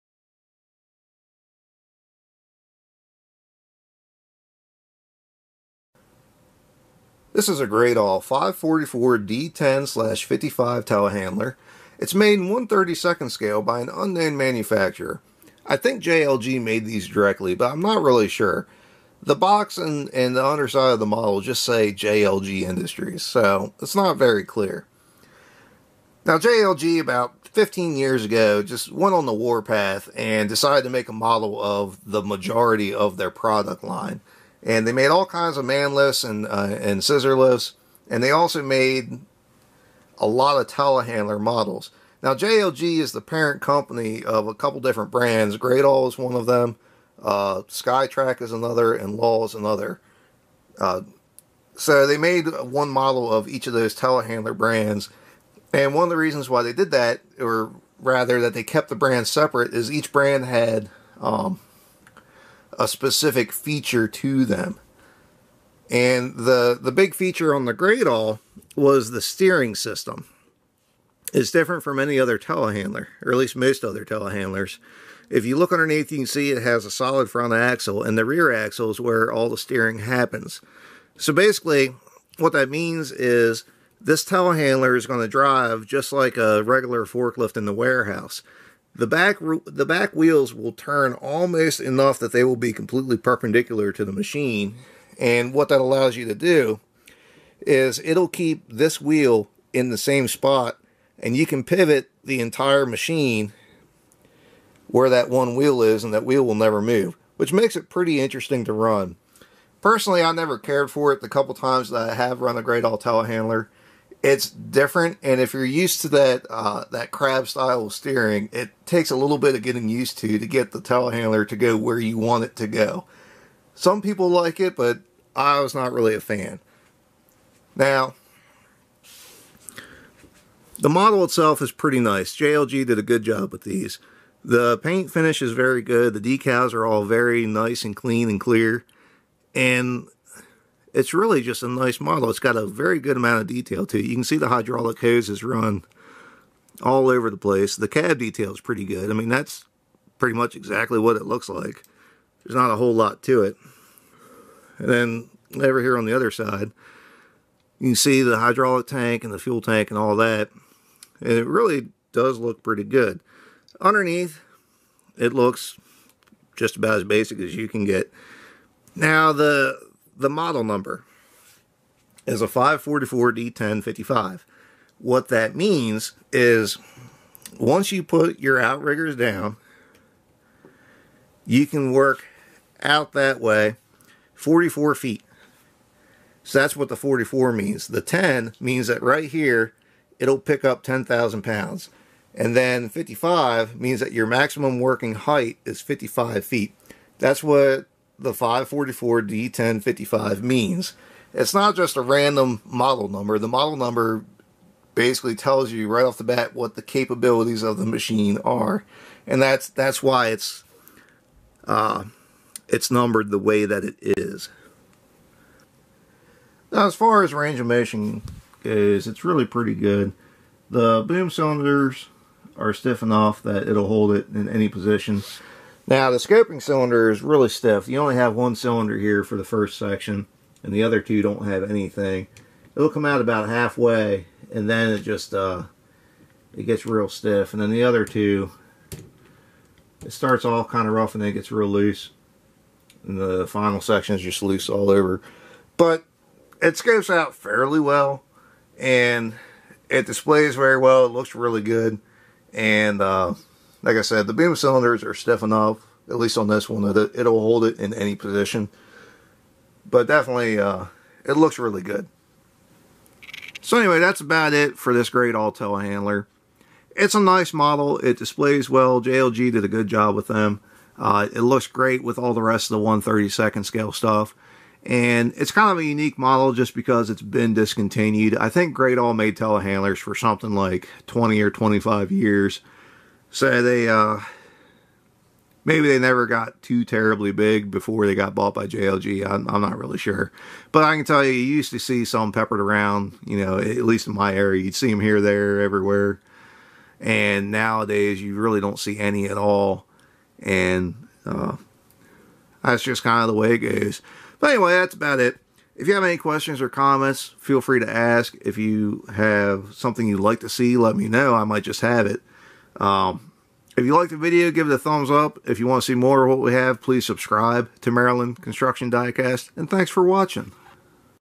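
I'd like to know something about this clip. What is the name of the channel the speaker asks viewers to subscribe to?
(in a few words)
Maryland Construction Diecast.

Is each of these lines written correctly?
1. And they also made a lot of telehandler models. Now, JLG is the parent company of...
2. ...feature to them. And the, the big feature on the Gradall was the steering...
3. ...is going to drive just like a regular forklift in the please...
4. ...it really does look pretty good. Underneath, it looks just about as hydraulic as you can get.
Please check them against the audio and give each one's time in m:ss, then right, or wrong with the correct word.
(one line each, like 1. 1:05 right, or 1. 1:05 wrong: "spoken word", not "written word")
1. 0:38 right
2. 1:03 right
3. 1:24 wrong: "warehouse", not "please"
4. 2:41 wrong: "basic", not "hydraulic".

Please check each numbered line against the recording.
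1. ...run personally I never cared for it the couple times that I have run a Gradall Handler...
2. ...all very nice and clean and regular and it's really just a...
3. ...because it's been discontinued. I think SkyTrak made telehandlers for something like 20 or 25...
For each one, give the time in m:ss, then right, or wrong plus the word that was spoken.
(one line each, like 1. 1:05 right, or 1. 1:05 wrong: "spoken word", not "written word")
1. 1:48 right
2. 2:16 wrong: "clear", not "regular"
3. 4:36 wrong: "Gradall", not "SkyTrak".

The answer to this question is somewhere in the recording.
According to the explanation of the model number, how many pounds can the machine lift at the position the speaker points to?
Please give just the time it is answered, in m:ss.
3:10.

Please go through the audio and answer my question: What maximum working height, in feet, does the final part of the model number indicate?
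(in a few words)
55 feet.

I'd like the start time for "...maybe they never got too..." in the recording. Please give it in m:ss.
4:45.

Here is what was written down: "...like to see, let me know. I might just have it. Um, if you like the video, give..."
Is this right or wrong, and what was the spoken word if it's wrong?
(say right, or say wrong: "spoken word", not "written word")
right.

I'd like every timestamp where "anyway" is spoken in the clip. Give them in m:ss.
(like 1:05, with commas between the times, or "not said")
4:23, 5:04.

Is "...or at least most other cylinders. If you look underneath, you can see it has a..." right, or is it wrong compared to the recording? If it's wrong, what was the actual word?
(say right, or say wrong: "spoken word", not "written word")
wrong: "telehandlers", not "cylinders".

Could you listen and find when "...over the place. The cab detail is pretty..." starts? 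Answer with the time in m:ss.
2:27.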